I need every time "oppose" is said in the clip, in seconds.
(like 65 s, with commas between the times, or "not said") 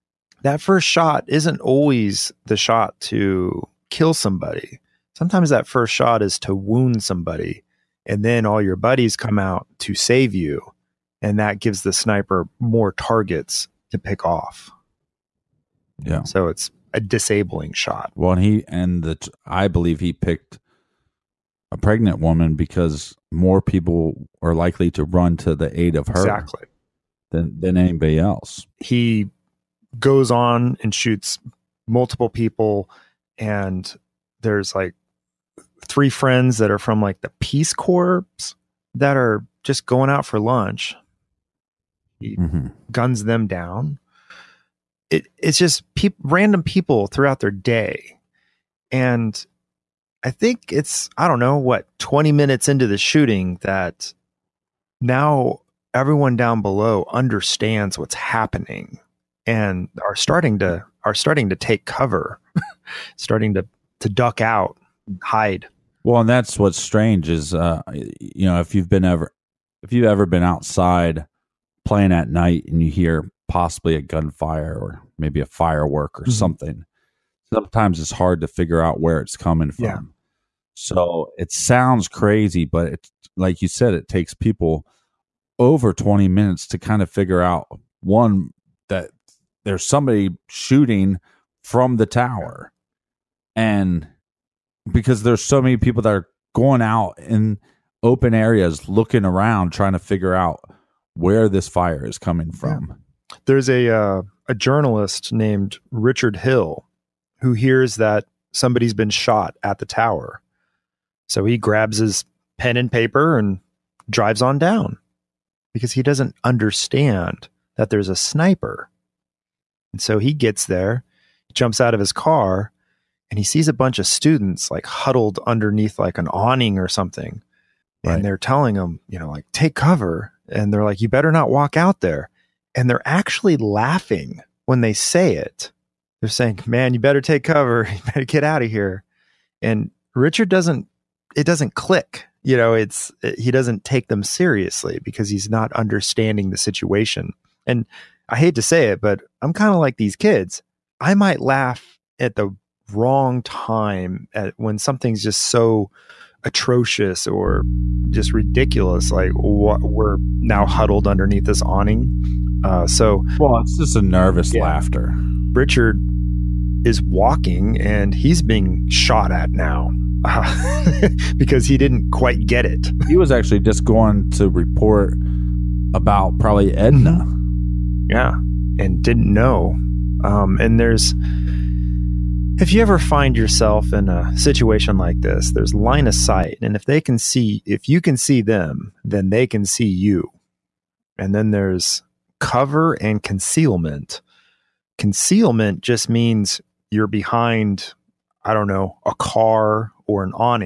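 not said.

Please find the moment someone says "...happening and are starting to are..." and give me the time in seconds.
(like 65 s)
58 s.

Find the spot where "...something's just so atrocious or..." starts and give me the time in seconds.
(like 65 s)
154 s.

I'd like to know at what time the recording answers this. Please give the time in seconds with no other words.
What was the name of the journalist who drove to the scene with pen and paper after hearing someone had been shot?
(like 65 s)
105 s.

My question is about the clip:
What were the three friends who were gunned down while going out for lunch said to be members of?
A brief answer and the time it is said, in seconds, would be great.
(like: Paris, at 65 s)
the Peace Corps, at 37 s.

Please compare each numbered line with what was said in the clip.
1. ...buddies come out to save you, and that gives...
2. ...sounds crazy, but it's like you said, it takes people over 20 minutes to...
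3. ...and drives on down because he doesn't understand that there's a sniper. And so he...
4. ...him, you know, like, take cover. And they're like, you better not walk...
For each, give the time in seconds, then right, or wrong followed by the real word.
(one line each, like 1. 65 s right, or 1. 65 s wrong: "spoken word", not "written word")
1. 8 s right
2. 81 s right
3. 113 s right
4. 128 s right.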